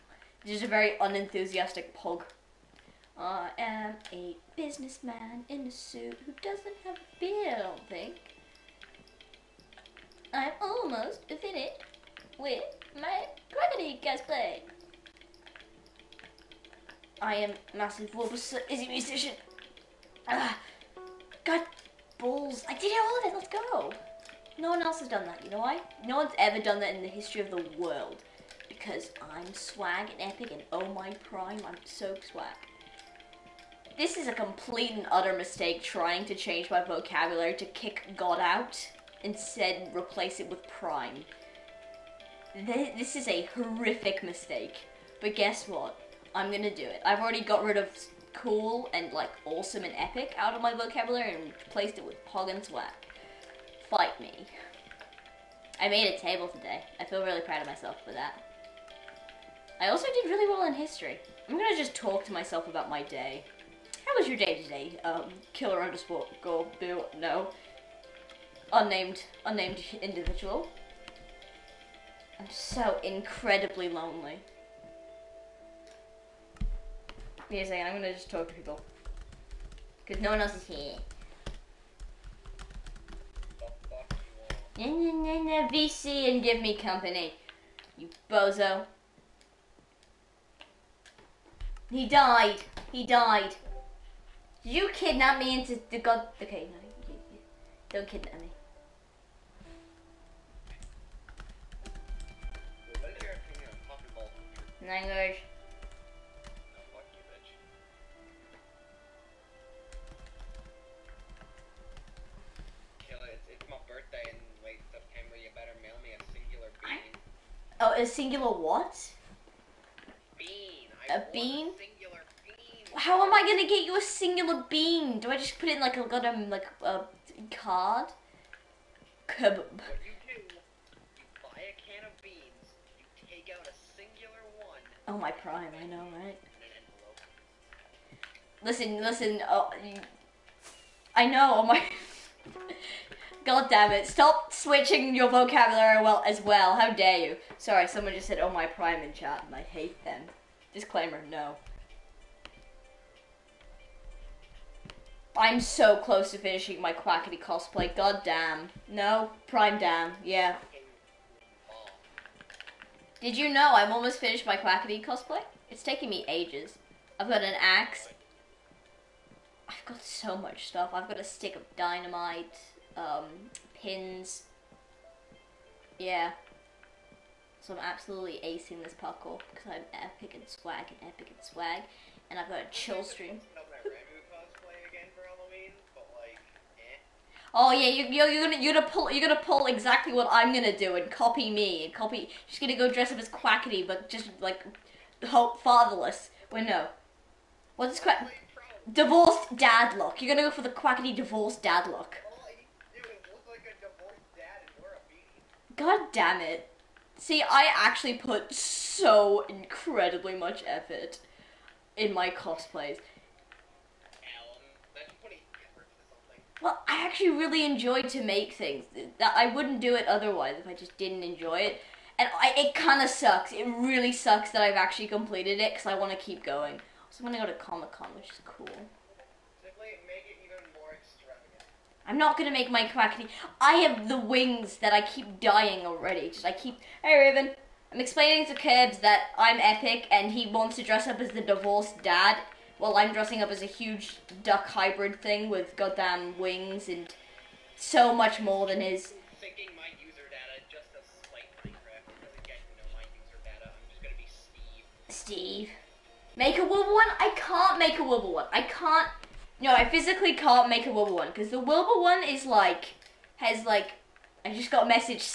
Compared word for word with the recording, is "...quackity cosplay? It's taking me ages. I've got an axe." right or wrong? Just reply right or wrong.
right.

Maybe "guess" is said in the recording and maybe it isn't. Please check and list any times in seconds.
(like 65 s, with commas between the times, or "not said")
45 s.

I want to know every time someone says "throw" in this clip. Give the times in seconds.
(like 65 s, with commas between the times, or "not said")
not said.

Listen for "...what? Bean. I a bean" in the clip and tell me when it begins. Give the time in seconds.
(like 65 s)
118 s.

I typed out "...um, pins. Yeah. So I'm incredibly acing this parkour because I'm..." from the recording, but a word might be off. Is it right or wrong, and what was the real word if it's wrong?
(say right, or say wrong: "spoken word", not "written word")
wrong: "absolutely", not "incredibly".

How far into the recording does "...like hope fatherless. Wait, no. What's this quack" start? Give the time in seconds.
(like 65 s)
194 s.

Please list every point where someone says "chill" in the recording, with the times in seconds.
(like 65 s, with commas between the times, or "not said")
182 s.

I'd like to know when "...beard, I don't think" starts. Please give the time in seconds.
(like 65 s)
7 s.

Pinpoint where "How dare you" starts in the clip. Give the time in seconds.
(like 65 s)
146 s.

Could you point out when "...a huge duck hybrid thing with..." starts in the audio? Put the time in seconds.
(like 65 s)
243 s.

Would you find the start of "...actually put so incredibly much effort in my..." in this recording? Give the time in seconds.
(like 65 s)
207 s.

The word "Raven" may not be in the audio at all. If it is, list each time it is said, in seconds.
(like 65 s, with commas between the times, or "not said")
237 s.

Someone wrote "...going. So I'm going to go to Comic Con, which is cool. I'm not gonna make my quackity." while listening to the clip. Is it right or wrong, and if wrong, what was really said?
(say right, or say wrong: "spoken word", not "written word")
right.